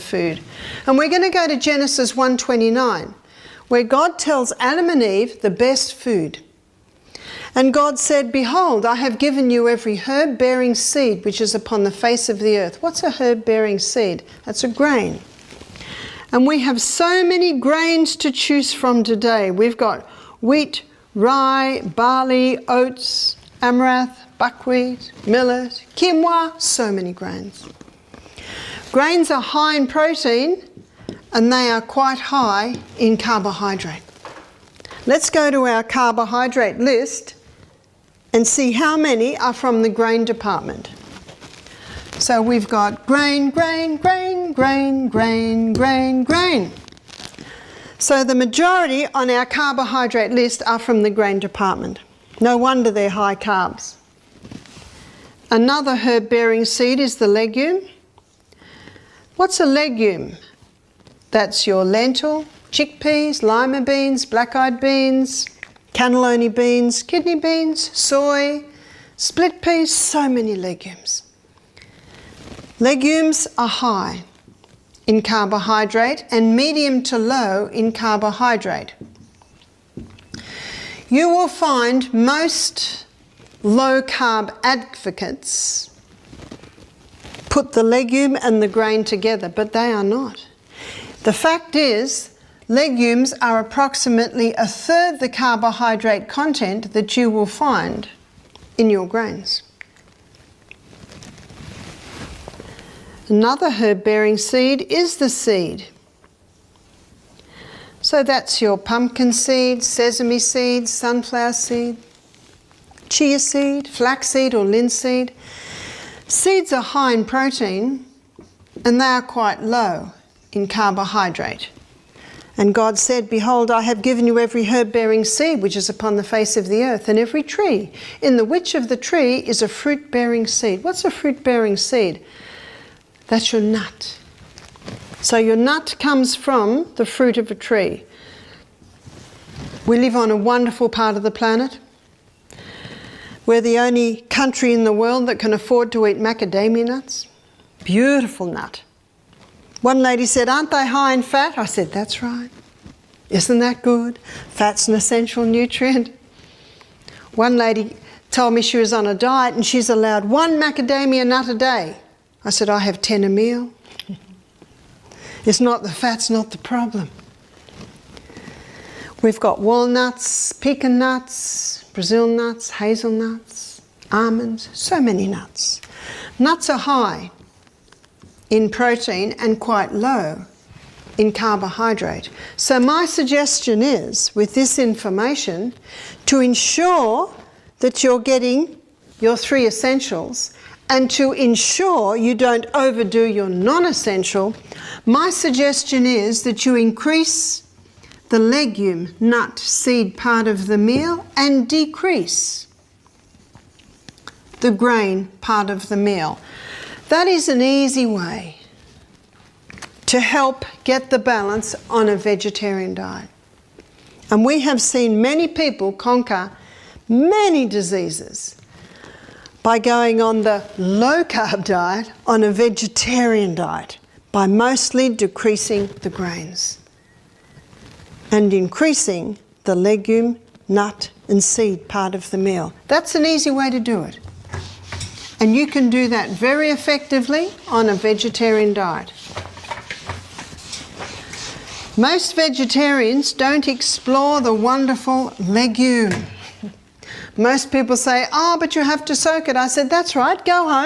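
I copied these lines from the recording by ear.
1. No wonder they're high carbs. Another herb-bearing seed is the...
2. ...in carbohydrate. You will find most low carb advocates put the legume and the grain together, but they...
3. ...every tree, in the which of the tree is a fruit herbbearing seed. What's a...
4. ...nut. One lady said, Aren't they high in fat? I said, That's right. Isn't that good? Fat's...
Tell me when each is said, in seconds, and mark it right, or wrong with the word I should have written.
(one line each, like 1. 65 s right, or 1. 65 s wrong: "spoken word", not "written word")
1. 52 s right
2. 77 s right
3. 127 s wrong: "bearing", not "herbbearing"
4. 148 s right.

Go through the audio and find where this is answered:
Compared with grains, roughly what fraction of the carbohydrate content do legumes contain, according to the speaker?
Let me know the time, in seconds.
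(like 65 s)
94 s.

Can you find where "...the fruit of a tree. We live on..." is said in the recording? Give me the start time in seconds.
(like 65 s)
136 s.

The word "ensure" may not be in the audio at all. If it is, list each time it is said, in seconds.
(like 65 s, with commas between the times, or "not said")
186 s, 191 s.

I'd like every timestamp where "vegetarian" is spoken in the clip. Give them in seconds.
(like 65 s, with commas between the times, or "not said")
212 s, 222 s, 237 s, 242 s.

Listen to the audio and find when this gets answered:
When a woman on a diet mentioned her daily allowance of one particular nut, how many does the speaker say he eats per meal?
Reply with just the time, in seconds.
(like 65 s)
163 s.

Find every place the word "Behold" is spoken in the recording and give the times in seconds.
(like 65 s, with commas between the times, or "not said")
8 s, 123 s.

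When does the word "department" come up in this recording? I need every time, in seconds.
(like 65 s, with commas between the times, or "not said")
40 s, 51 s.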